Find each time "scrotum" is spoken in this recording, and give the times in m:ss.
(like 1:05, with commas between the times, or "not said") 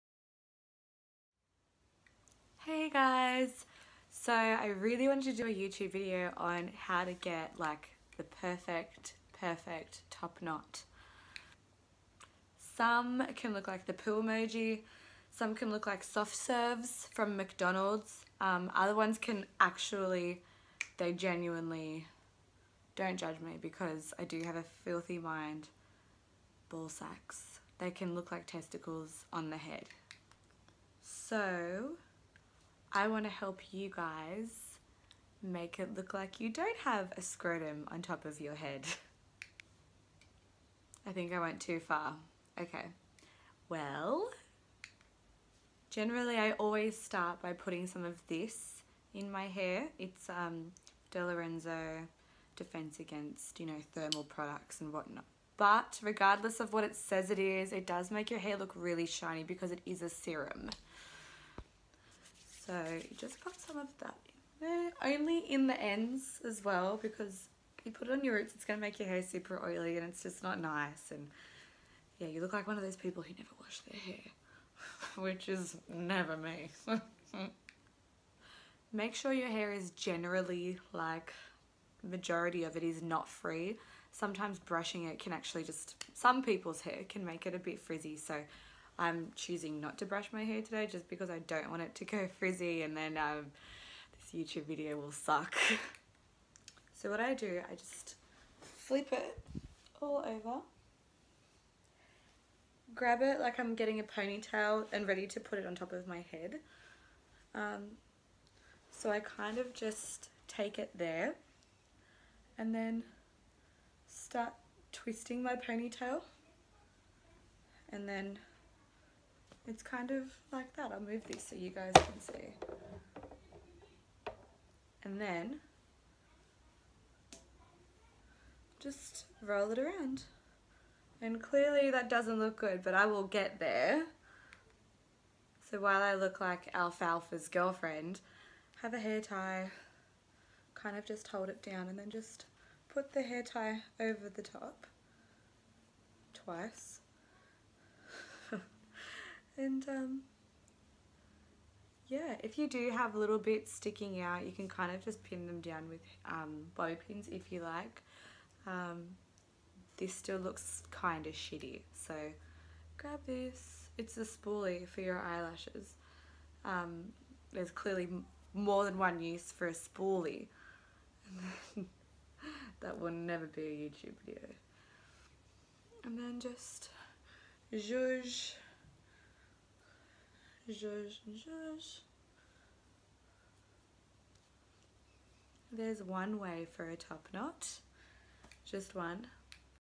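0:37.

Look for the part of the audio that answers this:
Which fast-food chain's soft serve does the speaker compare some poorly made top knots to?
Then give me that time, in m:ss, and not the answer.
0:17.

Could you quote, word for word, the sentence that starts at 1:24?
Sometimes brushing it can actually just, some people's hair can make it a bit frizzy.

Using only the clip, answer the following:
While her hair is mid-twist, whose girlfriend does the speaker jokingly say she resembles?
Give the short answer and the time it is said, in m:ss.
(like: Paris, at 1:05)
Alfalfa, at 2:16.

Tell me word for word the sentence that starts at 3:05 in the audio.
There's one way for a top knot, just one.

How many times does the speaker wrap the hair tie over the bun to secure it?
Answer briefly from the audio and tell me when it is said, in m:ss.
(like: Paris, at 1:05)
2, at 2:26.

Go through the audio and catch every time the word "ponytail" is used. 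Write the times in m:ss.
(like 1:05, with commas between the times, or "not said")
1:44, 1:55.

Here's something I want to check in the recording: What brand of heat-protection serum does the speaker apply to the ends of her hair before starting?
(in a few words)
De Lorenzo.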